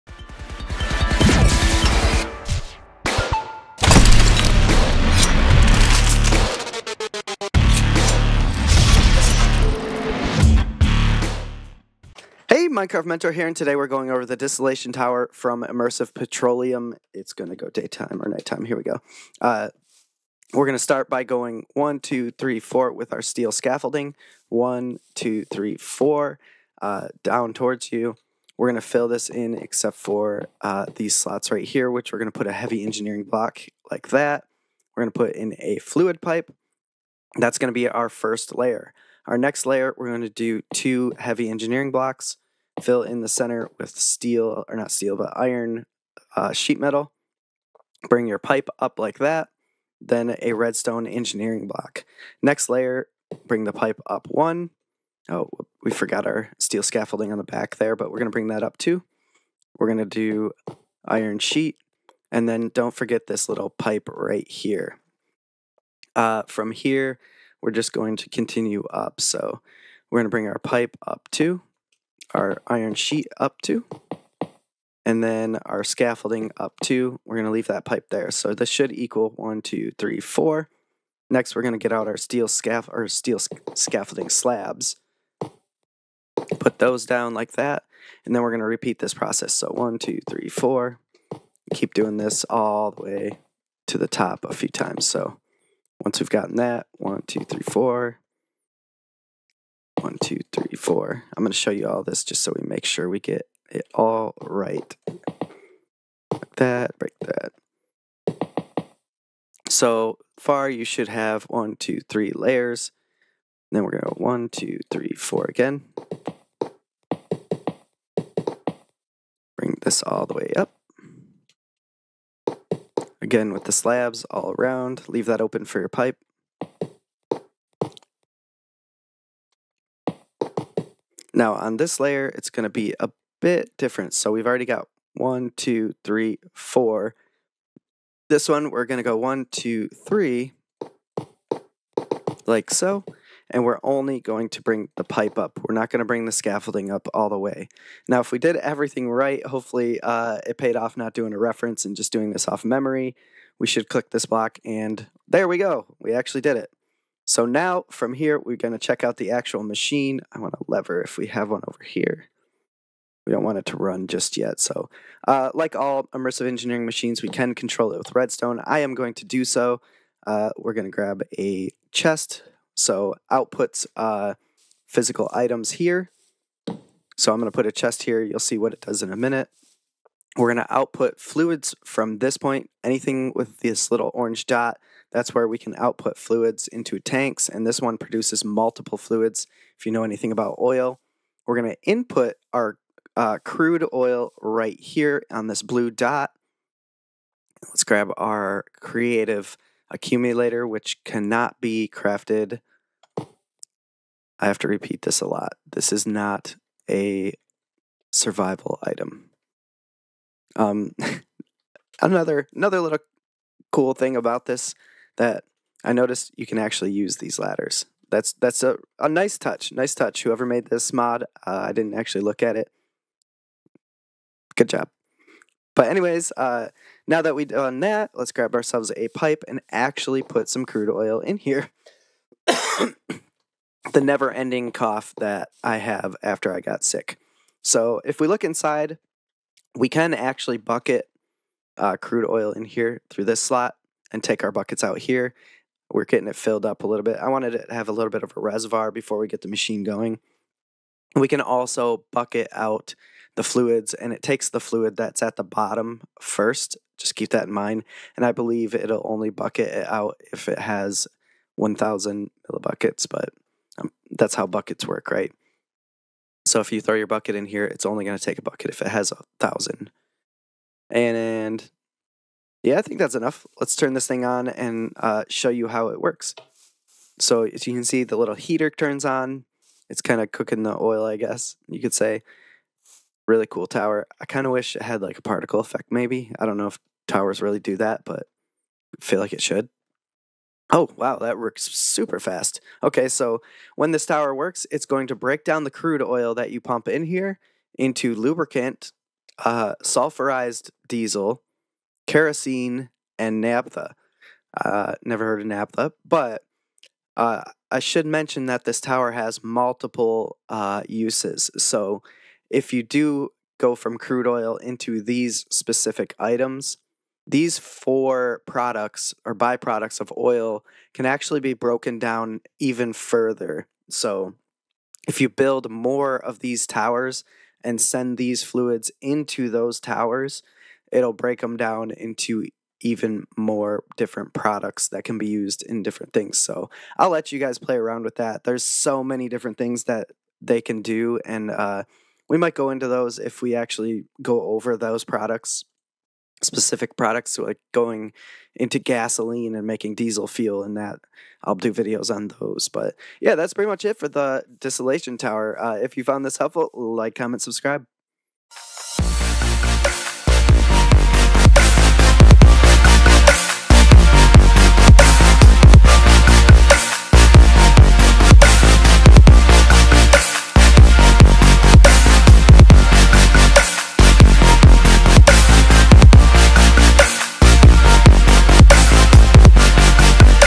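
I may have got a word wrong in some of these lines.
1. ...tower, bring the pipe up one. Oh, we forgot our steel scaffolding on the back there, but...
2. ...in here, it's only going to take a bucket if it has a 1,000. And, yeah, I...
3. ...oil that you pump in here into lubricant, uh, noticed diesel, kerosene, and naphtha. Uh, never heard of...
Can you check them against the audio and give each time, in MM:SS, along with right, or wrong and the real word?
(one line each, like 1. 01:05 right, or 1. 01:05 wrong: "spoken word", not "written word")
1. 00:52 wrong: "layer", not "tower"
2. 04:27 right
3. 04:56 wrong: "sulfurized", not "noticed".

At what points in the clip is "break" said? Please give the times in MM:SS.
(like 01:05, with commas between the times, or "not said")
01:46, 04:55, 05:31.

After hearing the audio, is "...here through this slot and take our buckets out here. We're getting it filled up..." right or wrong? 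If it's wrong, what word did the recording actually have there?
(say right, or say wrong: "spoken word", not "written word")
right.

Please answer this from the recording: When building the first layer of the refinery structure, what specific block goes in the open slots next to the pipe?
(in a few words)
heavy engineering block.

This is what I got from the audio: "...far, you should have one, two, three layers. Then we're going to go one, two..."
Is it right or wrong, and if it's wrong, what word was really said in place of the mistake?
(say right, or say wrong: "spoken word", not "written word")
right.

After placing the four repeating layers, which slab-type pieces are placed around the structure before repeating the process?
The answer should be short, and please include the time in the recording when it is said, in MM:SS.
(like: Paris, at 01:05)
steel scaffolding slabs, at 01:23.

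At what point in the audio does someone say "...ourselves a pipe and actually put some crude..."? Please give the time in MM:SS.
03:48.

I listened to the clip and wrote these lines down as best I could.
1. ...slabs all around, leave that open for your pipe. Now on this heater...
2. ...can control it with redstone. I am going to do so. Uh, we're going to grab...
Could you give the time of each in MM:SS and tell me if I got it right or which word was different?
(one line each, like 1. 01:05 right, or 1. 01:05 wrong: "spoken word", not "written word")
1. 02:03 wrong: "layer", not "heater"
2. 02:47 right.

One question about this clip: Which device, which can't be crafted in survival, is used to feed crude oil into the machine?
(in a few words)
creative accumulator.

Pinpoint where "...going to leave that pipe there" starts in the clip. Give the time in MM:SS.
01:17.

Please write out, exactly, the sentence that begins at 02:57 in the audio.
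So I'm going to put a chest here.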